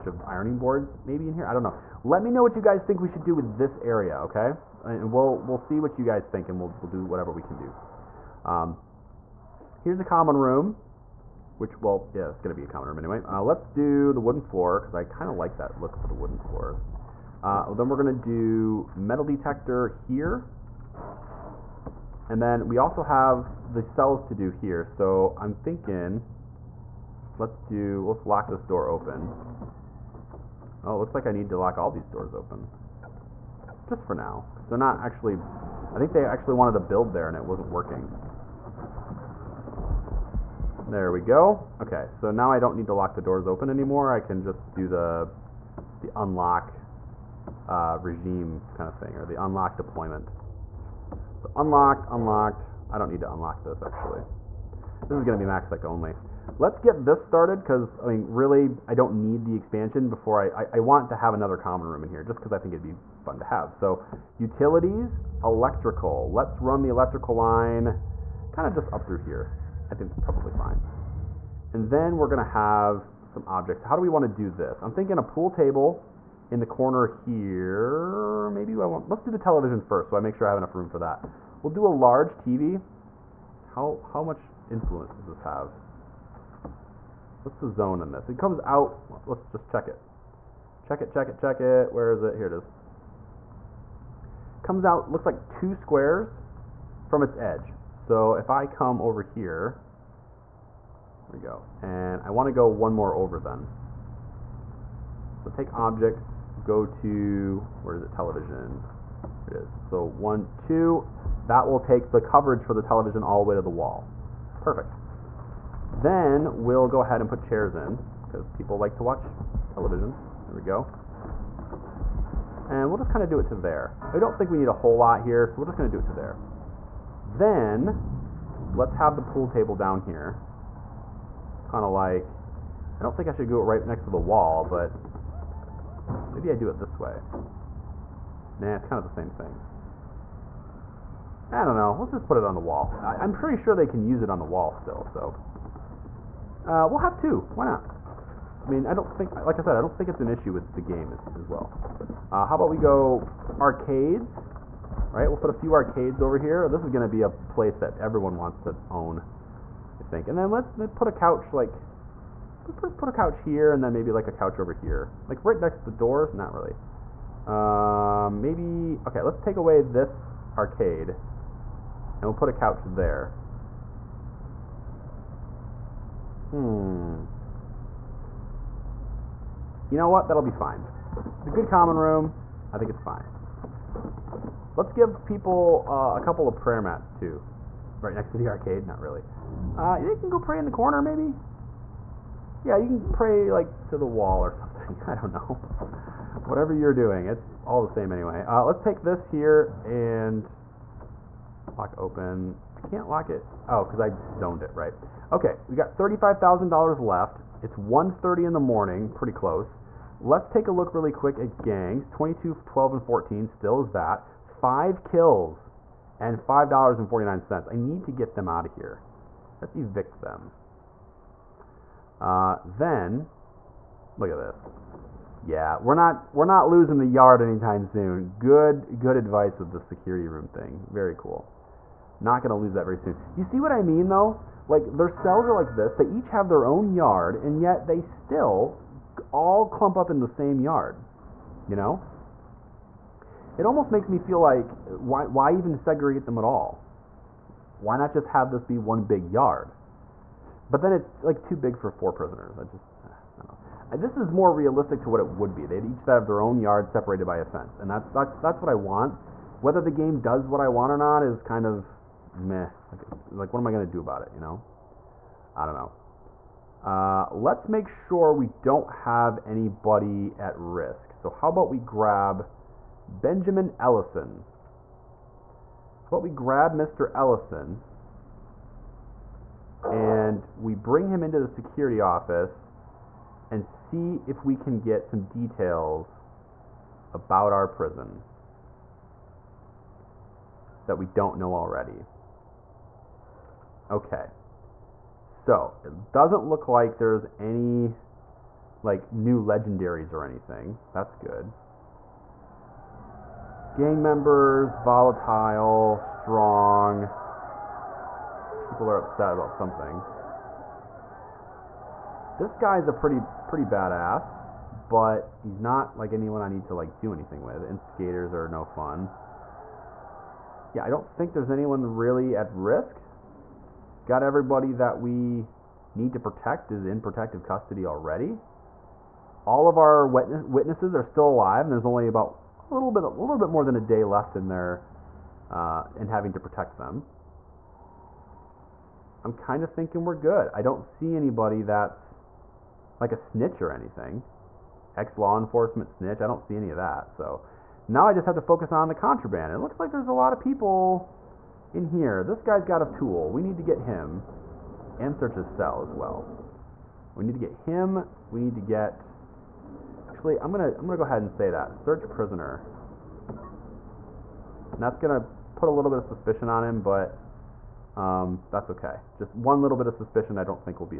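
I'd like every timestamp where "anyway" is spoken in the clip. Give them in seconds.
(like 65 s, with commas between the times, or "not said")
12 s, 198 s.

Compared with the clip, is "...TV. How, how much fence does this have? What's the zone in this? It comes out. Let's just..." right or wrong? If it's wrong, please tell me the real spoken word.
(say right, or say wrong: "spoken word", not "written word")
wrong: "influence", not "fence".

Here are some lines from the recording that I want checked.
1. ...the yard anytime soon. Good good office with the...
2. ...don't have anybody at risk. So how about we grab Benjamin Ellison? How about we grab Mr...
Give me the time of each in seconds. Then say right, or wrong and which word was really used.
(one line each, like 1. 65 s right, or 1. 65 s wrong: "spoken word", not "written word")
1. 226 s wrong: "advice", not "office"
2. 268 s right.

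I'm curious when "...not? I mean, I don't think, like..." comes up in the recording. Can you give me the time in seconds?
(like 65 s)
147 s.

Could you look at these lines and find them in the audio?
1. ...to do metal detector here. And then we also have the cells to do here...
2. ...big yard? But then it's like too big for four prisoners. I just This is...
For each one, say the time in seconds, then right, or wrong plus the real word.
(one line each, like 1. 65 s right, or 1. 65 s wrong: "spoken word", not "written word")
1. 18 s right
2. 249 s right.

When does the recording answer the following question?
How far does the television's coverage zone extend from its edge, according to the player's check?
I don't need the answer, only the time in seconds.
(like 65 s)
95 s.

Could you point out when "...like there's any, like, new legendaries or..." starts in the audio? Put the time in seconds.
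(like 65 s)
296 s.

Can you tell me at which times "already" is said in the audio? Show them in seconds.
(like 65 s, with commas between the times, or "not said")
291 s, 327 s.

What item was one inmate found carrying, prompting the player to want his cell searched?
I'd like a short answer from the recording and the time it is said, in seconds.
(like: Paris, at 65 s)
A tool, at 352 s.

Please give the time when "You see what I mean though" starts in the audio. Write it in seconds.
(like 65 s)
233 s.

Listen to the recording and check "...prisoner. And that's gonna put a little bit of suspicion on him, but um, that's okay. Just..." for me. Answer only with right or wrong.
right.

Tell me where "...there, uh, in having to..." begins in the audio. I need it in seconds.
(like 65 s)
334 s.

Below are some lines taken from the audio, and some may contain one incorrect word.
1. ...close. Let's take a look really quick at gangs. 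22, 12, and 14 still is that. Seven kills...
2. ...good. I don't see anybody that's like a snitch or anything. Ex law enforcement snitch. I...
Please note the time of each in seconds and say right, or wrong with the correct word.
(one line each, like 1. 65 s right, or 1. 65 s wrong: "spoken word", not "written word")
1. 209 s wrong: "Five", not "Seven"
2. 340 s right.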